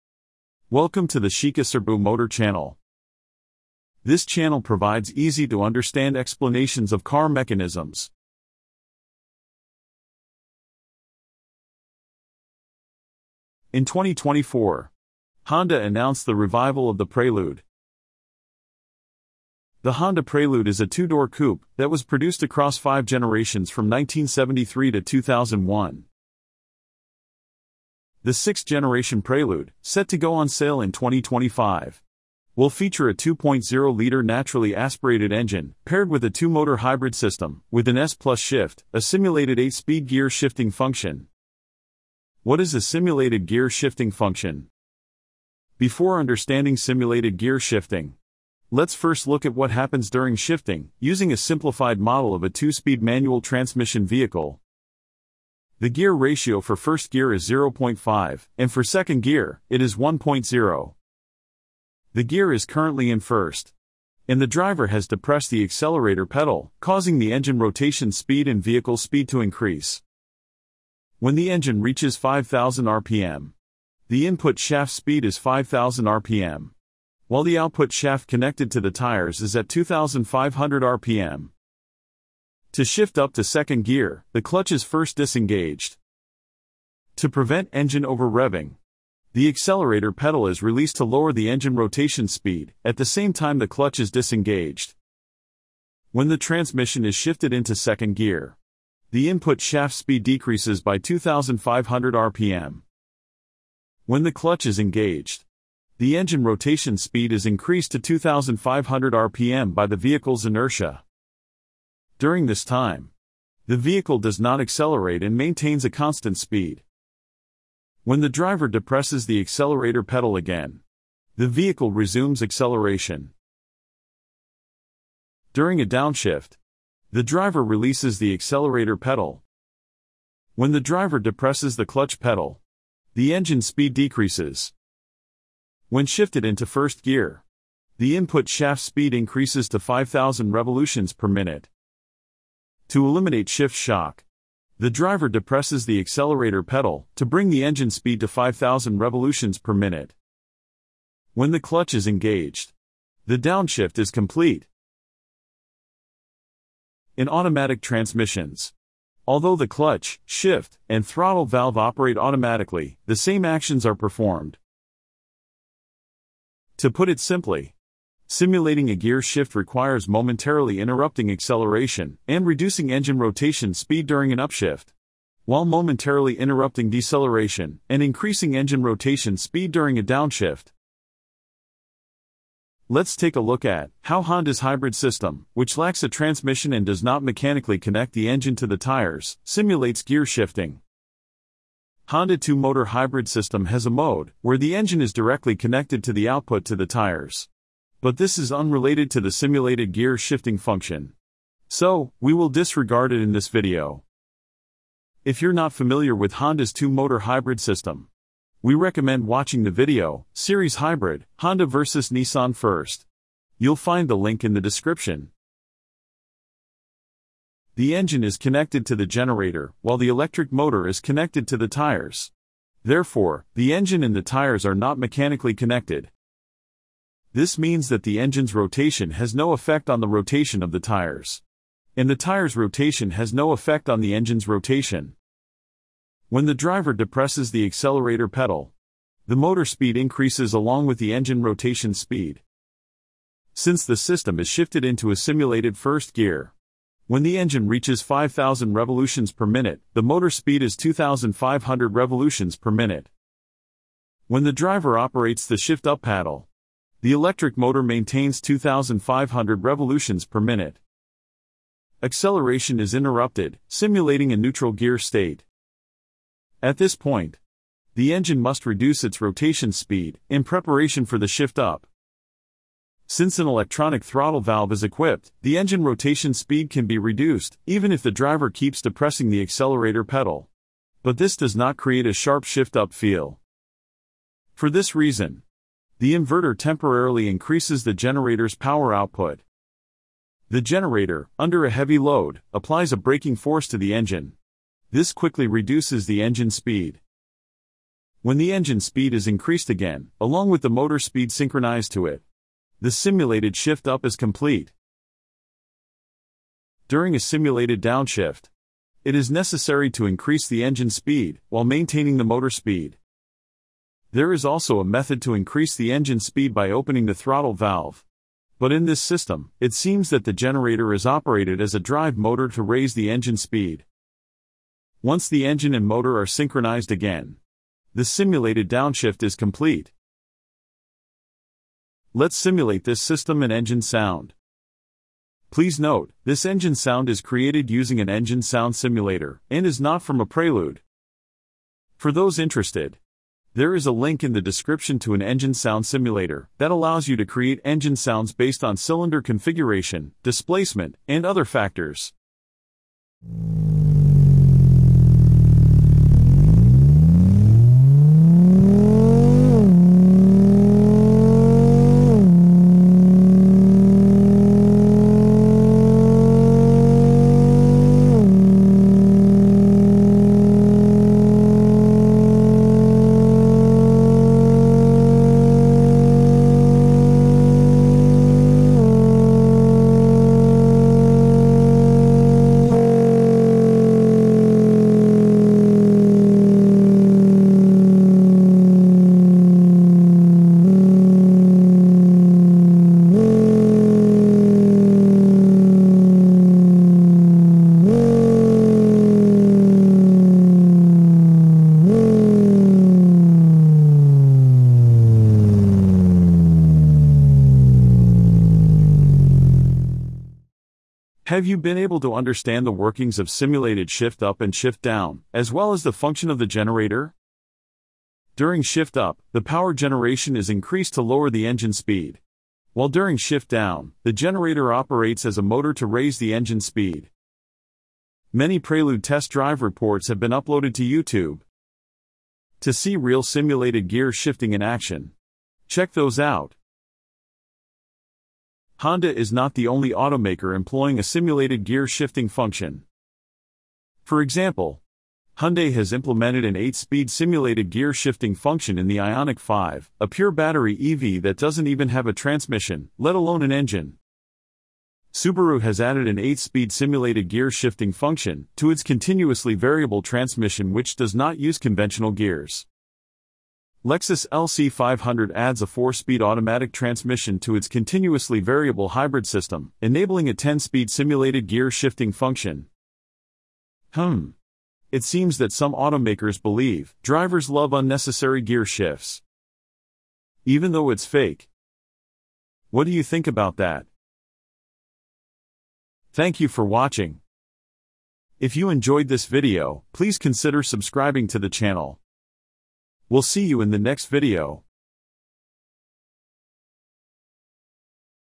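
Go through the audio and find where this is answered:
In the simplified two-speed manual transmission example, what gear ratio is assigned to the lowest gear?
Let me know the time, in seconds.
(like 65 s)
57 s.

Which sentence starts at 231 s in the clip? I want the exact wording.
And the tire's rotation has no effect on the engine's rotation.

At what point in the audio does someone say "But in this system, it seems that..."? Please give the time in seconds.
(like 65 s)
318 s.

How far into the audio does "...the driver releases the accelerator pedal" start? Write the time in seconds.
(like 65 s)
127 s.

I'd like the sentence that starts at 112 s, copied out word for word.
During this time, the vehicle does not accelerate and maintains a constant speed.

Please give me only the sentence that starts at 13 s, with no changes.
In 2024, Honda announced the revival of the Prelude.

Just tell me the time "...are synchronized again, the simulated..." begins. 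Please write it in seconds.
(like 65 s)
326 s.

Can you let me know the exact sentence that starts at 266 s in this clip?
At this point, the engine must reduce its rotation speed in preparation for the shift up.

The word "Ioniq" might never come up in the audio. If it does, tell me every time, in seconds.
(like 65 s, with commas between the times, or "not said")
448 s.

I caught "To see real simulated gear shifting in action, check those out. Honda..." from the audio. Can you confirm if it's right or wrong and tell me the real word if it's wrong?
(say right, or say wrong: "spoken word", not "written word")
right.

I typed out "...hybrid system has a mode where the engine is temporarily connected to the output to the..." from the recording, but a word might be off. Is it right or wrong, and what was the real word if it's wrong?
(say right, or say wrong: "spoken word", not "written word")
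wrong: "directly", not "temporarily".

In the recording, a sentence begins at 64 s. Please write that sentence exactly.
And the driver has depressed the accelerator pedal, causing the engine rotation speed and vehicle speed to increase.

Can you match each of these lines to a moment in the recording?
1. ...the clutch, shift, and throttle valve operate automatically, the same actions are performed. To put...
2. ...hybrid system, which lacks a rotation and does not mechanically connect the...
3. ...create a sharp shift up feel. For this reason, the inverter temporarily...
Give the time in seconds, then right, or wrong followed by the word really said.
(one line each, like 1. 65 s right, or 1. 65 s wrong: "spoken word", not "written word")
1. 159 s right
2. 184 s wrong: "transmission", not "rotation"
3. 281 s right.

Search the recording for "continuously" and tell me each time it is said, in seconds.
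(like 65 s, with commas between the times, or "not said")
458 s, 467 s.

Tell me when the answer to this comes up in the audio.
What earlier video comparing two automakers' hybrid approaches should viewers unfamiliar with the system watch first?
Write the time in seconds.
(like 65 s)
210 s.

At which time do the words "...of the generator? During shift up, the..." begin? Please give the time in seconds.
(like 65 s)
416 s.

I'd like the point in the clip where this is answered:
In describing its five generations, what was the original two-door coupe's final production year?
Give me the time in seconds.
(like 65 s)
25 s.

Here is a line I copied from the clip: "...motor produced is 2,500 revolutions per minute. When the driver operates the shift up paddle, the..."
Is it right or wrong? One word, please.
wrong.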